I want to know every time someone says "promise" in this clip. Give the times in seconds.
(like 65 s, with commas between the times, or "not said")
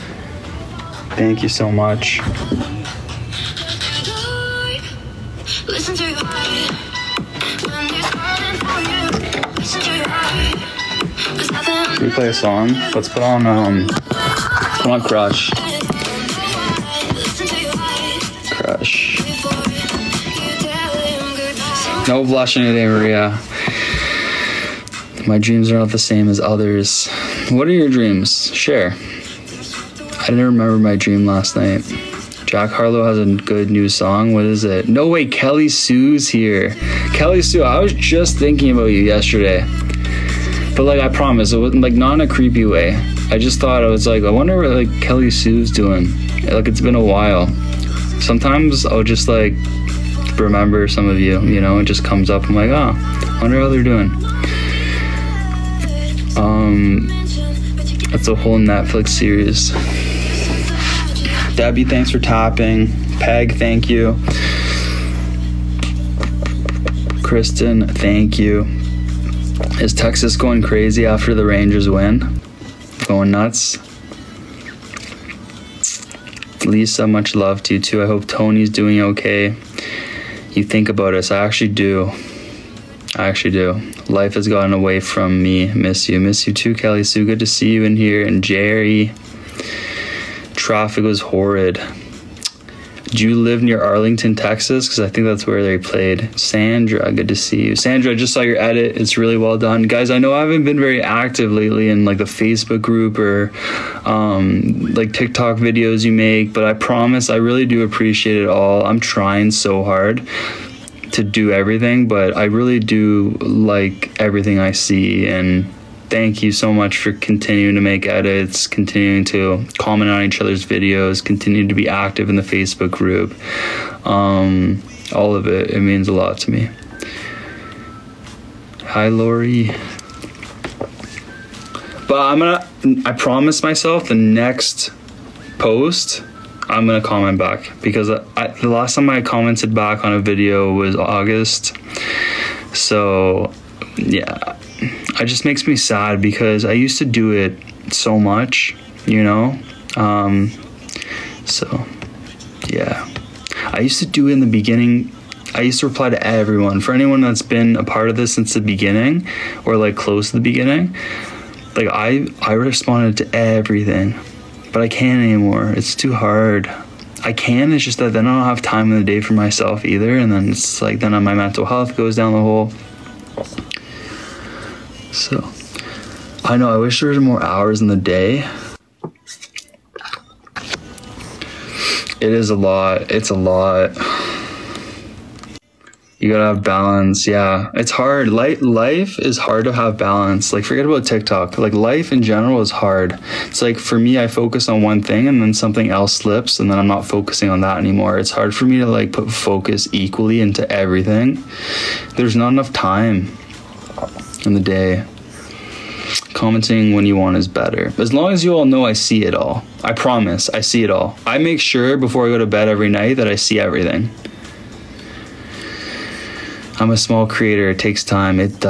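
41 s, 106 s, 133 s, 209 s.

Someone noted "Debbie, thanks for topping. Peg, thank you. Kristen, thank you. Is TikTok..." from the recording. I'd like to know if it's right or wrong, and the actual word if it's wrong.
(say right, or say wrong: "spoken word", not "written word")
wrong: "Texas", not "TikTok".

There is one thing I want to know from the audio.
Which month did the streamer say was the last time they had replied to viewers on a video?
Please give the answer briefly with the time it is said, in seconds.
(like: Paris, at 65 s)
August, at 140 s.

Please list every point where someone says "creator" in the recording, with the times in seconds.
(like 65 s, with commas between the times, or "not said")
217 s.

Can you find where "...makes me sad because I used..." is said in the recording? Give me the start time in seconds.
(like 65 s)
145 s.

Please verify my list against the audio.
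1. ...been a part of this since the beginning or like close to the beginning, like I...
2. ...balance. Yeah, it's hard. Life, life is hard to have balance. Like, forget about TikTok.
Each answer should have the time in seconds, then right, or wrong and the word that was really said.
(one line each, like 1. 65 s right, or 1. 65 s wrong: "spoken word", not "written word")
1. 157 s right
2. 186 s right.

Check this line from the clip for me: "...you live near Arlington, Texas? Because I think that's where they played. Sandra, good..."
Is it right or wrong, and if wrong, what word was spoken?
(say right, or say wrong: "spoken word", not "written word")
right.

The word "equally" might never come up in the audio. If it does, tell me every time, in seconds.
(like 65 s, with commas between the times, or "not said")
199 s.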